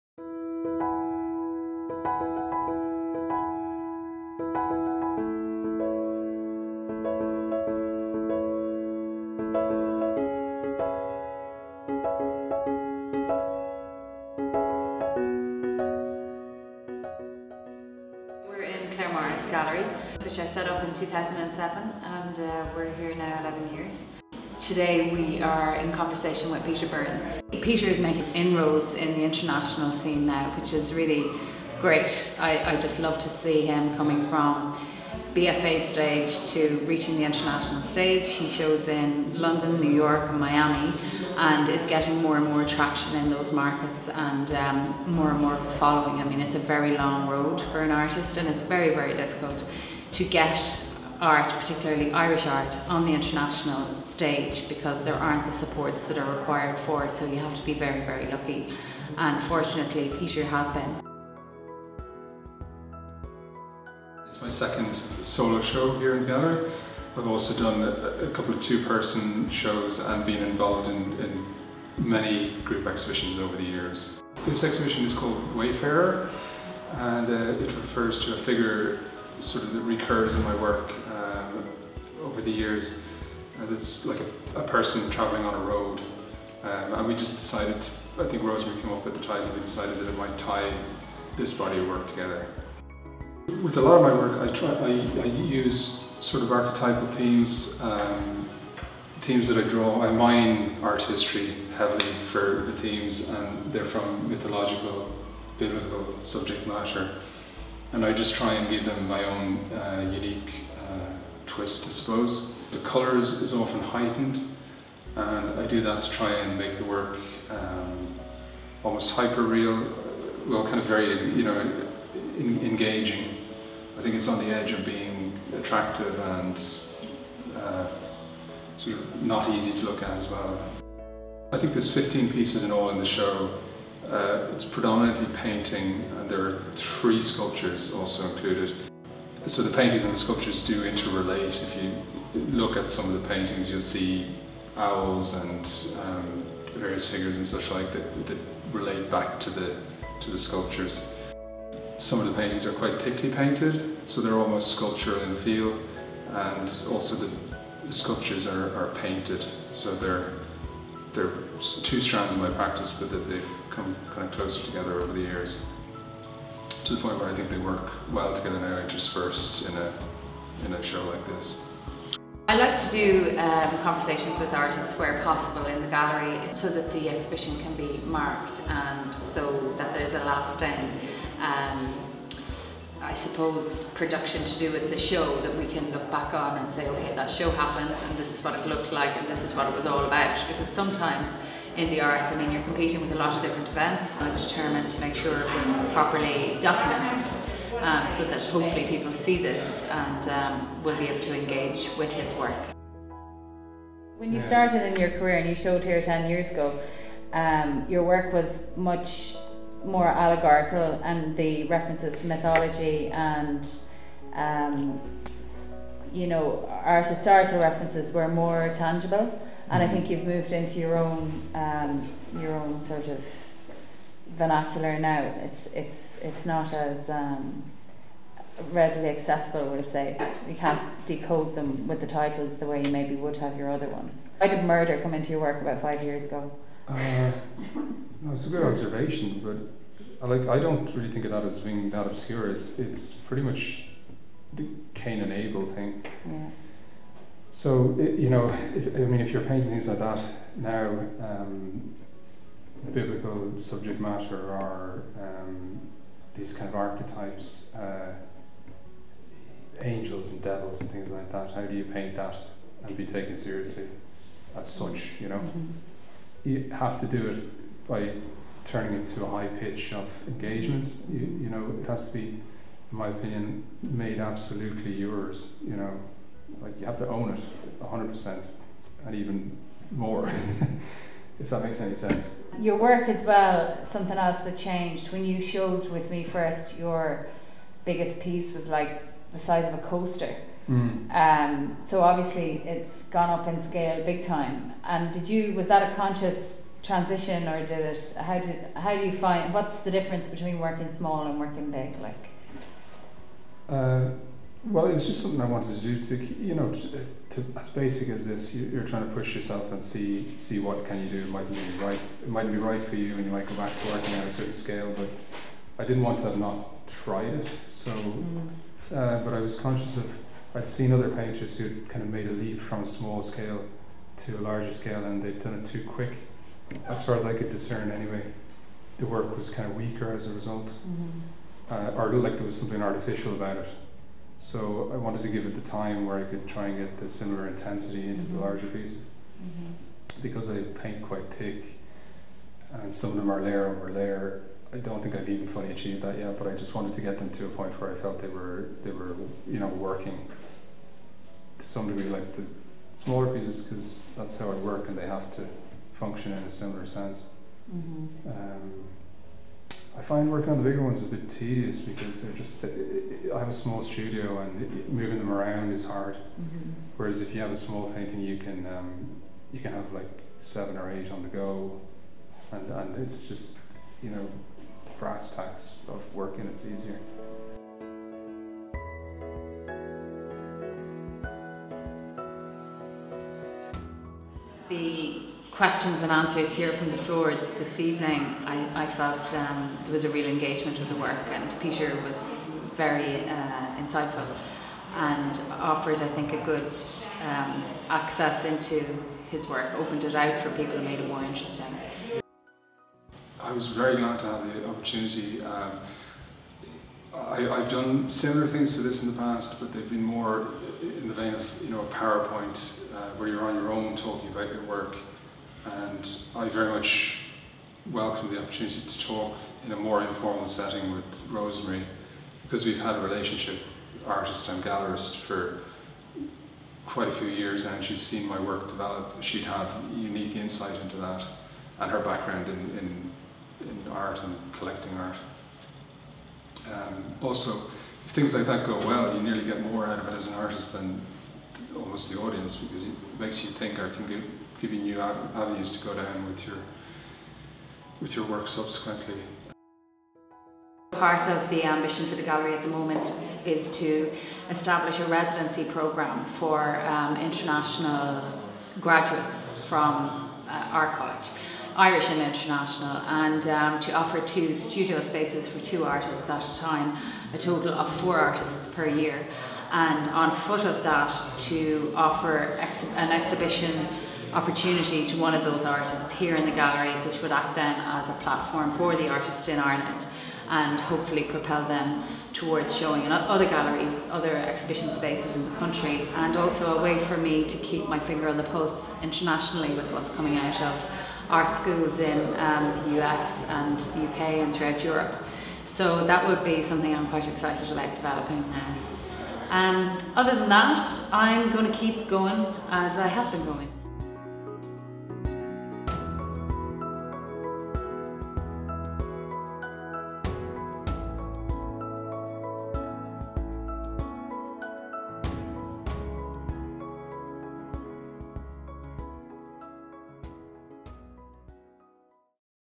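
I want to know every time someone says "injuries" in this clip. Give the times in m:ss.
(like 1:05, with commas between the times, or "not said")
not said.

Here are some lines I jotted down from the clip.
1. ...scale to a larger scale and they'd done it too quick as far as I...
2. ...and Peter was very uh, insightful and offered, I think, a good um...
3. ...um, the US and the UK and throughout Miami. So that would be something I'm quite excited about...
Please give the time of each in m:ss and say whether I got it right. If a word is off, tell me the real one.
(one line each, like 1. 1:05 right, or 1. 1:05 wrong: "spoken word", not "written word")
1. 5:23 right
2. 6:31 right
3. 8:12 wrong: "Europe", not "Miami".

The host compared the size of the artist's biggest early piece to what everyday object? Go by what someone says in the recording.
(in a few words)
a coaster.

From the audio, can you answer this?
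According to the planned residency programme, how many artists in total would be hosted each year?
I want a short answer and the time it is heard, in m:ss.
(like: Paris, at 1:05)
4, at 7:48.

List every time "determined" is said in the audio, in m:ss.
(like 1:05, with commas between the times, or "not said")
3:14.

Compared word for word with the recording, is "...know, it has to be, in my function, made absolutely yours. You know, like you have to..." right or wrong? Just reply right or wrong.
wrong.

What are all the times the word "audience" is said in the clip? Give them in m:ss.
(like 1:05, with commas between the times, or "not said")
7:22.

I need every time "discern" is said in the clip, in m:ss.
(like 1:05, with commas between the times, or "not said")
5:27.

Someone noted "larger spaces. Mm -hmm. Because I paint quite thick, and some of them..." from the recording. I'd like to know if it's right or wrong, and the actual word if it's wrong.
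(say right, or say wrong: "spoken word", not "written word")
wrong: "pieces", not "spaces".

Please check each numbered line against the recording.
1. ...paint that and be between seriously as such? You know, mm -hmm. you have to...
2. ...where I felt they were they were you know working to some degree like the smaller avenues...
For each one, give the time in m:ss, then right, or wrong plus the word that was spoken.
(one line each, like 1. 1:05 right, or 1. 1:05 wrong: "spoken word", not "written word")
1. 4:21 wrong: "taken", not "between"
2. 5:47 wrong: "pieces", not "avenues".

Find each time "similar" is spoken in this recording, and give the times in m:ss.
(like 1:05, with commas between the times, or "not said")
5:37, 5:56, 6:48.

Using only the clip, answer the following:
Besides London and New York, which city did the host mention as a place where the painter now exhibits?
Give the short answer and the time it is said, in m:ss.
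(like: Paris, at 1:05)
Miami, at 0:40.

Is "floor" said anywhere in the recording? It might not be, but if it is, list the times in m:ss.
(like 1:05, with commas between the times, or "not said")
6:26.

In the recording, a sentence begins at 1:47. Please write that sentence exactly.
And I just try and give them my own uh, unique uh, twist, I suppose.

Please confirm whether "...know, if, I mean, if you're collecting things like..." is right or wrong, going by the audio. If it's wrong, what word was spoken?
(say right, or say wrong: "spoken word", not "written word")
wrong: "painting", not "collecting".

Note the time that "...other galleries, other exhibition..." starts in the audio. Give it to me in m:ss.
8:03.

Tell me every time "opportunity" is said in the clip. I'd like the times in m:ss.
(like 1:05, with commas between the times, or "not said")
6:44, 6:58, 7:54.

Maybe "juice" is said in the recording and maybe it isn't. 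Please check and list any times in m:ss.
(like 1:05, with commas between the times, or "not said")
not said.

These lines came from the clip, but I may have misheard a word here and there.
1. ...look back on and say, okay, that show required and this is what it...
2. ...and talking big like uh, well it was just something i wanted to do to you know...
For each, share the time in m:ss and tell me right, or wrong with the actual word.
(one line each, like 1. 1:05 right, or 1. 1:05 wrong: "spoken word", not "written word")
1. 3:05 wrong: "happened", not "required"
2. 5:01 wrong: "working", not "talking".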